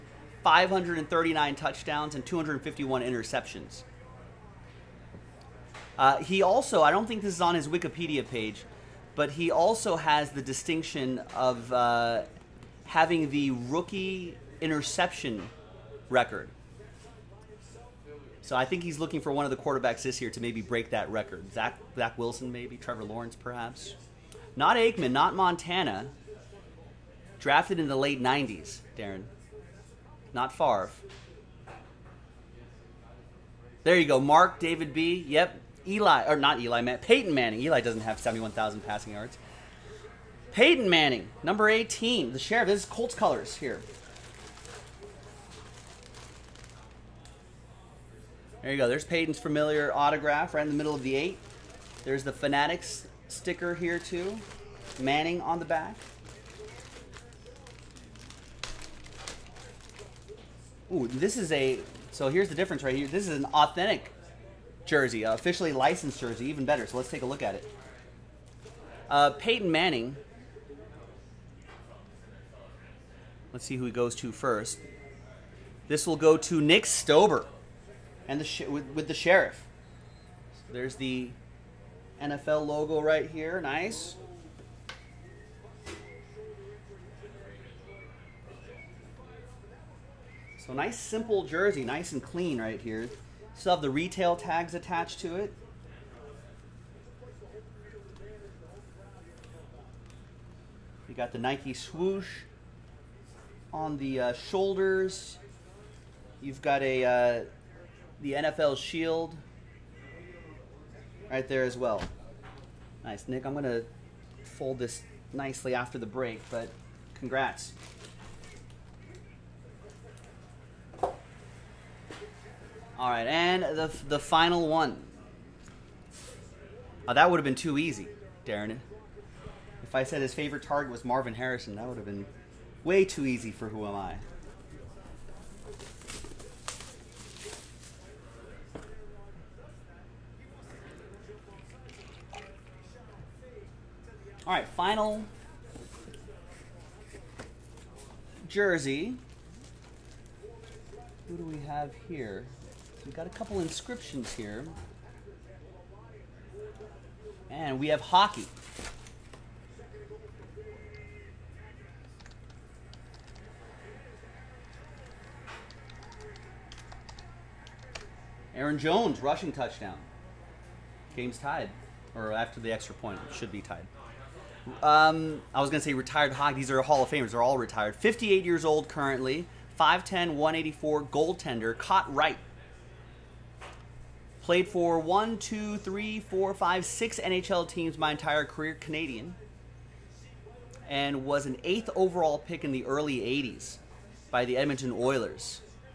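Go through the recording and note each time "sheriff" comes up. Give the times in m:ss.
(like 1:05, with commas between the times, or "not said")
0:42, 1:19.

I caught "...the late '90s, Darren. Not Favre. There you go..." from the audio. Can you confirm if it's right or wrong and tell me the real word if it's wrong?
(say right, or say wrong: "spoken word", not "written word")
right.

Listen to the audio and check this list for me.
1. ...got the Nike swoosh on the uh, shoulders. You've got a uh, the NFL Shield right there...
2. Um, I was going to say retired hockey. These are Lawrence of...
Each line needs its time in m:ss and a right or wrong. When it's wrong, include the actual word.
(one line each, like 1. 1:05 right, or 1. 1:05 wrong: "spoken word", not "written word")
1. 1:41 right
2. 2:54 wrong: "Hall", not "Lawrence".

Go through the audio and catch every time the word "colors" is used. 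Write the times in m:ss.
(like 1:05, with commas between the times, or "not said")
0:43.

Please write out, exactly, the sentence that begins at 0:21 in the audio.
Zach, Zach Wilson, maybe Trevor Lawrence, perhaps.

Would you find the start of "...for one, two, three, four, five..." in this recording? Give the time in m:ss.
3:04.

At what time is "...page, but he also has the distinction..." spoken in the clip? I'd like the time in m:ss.
0:08.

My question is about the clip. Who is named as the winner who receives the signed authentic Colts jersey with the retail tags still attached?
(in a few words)
Nick Stober.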